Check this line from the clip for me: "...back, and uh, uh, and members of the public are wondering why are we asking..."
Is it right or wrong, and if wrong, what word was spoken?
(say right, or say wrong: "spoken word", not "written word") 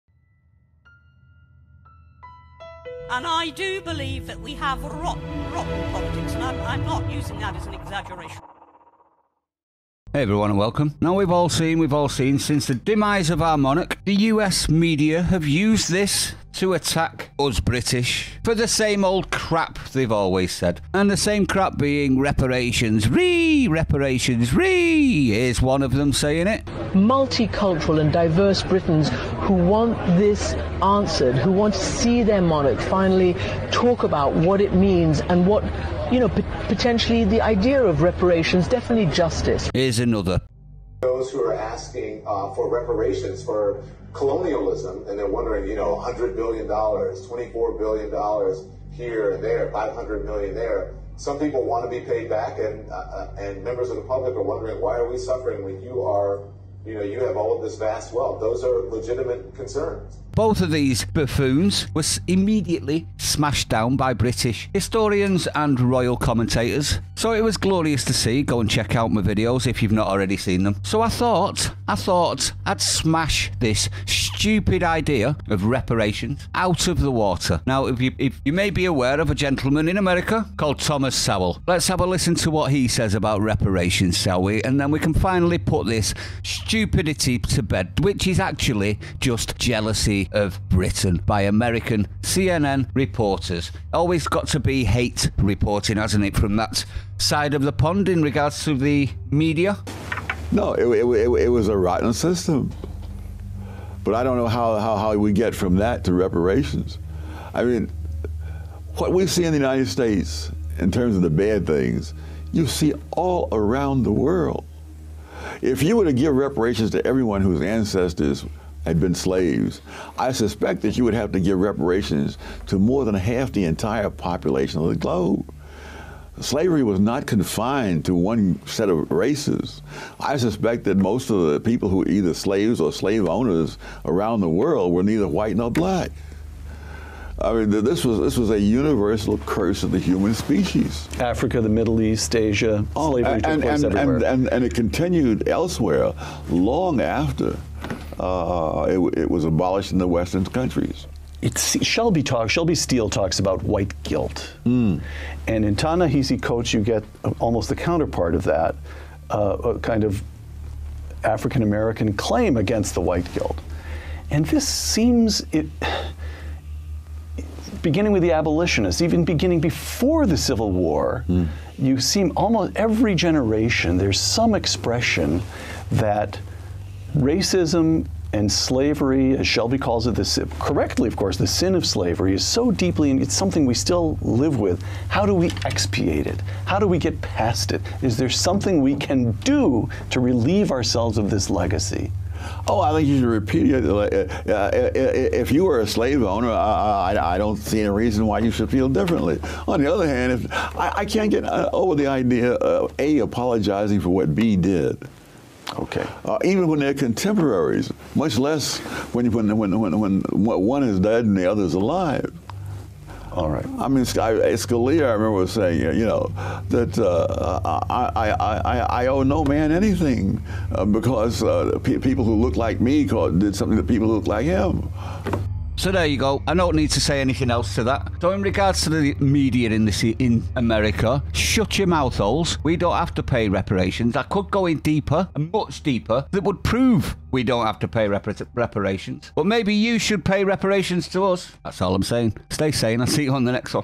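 wrong: "suffering", not "asking".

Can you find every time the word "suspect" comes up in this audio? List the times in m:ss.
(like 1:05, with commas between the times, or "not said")
2:00, 2:10.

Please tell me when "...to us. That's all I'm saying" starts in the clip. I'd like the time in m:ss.
4:01.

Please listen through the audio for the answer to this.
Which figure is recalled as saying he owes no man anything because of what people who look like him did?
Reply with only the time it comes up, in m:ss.
3:34.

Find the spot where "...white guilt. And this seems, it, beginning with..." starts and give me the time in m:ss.
2:43.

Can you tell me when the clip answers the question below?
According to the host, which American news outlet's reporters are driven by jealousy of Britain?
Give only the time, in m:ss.
1:32.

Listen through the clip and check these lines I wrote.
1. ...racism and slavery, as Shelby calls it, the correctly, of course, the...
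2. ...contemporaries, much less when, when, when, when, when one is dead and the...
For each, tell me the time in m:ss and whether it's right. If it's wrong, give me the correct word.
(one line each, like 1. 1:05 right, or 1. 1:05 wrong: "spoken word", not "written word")
1. 2:57 right
2. 3:26 right.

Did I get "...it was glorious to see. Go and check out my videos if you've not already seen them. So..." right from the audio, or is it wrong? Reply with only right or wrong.
right.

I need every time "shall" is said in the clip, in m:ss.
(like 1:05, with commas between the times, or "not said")
1:24.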